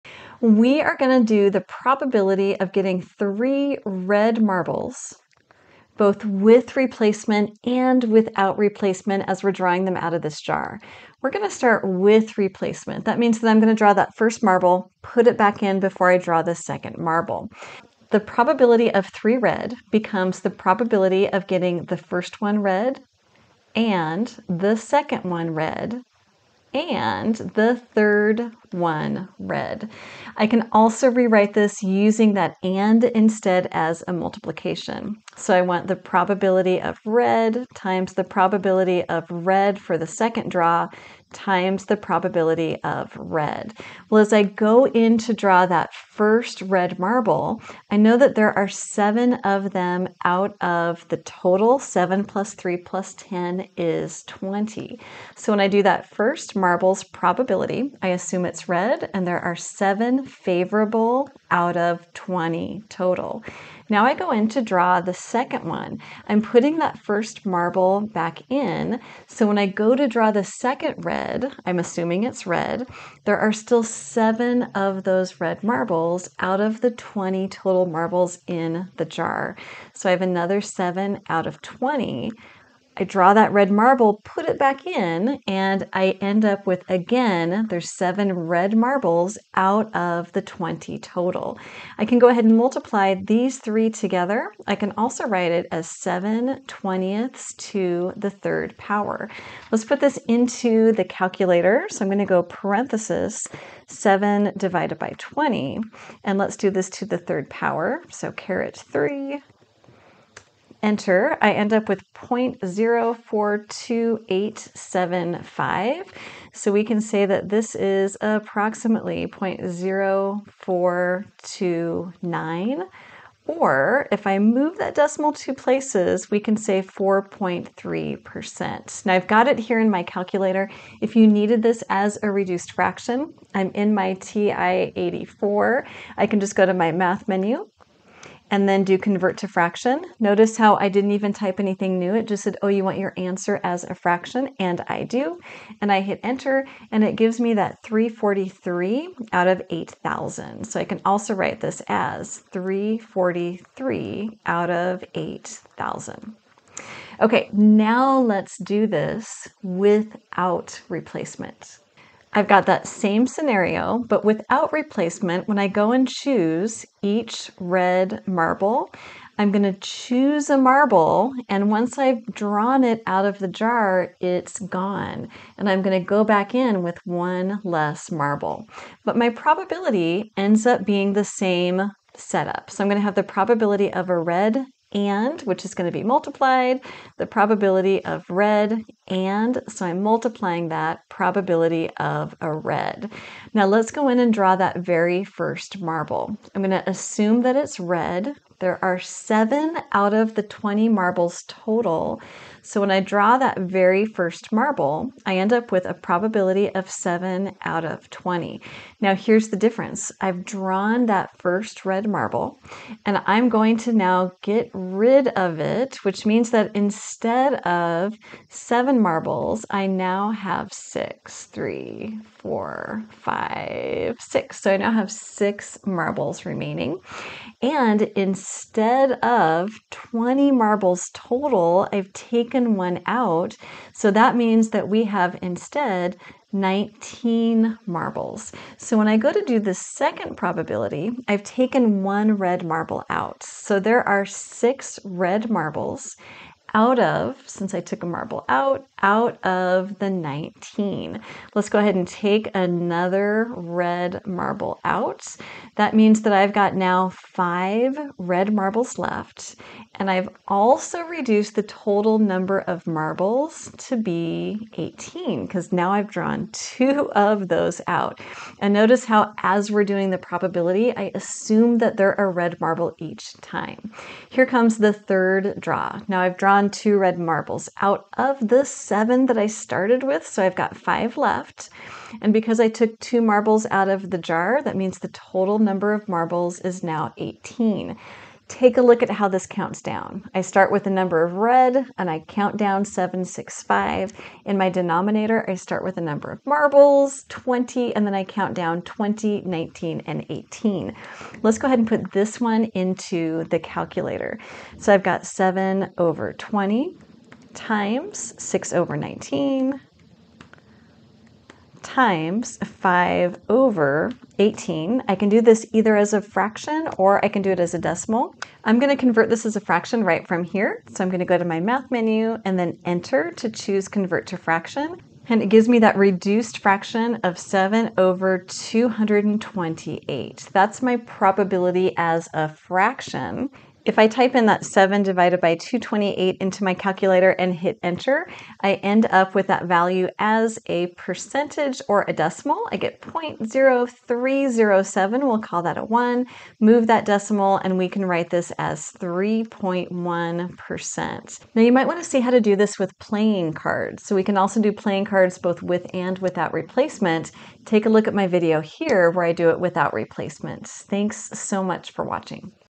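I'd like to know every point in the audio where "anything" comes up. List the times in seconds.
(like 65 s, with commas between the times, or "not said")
141 s.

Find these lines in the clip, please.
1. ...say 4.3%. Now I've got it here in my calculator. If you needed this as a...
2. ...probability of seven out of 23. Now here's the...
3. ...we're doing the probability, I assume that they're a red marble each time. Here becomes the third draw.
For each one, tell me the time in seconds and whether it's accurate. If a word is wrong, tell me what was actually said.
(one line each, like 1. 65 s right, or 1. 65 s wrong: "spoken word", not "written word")
1. 126 s right
2. 205 s wrong: "20", not "23"
3. 269 s wrong: "comes", not "becomes".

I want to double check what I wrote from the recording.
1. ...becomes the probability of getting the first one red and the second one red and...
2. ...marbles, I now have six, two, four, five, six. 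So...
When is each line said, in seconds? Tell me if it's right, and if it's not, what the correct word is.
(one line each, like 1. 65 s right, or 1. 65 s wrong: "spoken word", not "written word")
1. 19 s right
2. 219 s wrong: "three", not "two".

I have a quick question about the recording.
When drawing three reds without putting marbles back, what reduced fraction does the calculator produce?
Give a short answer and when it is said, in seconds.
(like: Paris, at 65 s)
7/228, at 327 s.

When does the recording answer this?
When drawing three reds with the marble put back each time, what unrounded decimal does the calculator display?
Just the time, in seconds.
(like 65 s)
112 s.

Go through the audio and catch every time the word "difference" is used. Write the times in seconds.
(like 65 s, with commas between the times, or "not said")
209 s.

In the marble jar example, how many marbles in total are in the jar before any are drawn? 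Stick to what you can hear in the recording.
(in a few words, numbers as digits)
20.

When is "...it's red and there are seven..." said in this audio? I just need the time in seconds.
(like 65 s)
58 s.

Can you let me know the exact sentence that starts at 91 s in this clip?
I can go ahead and multiply these three together.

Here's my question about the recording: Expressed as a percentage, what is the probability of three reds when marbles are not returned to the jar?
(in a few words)
3.1%.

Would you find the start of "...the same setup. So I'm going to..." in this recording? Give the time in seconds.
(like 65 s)
181 s.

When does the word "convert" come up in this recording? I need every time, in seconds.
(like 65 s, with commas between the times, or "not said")
138 s, 318 s, 323 s.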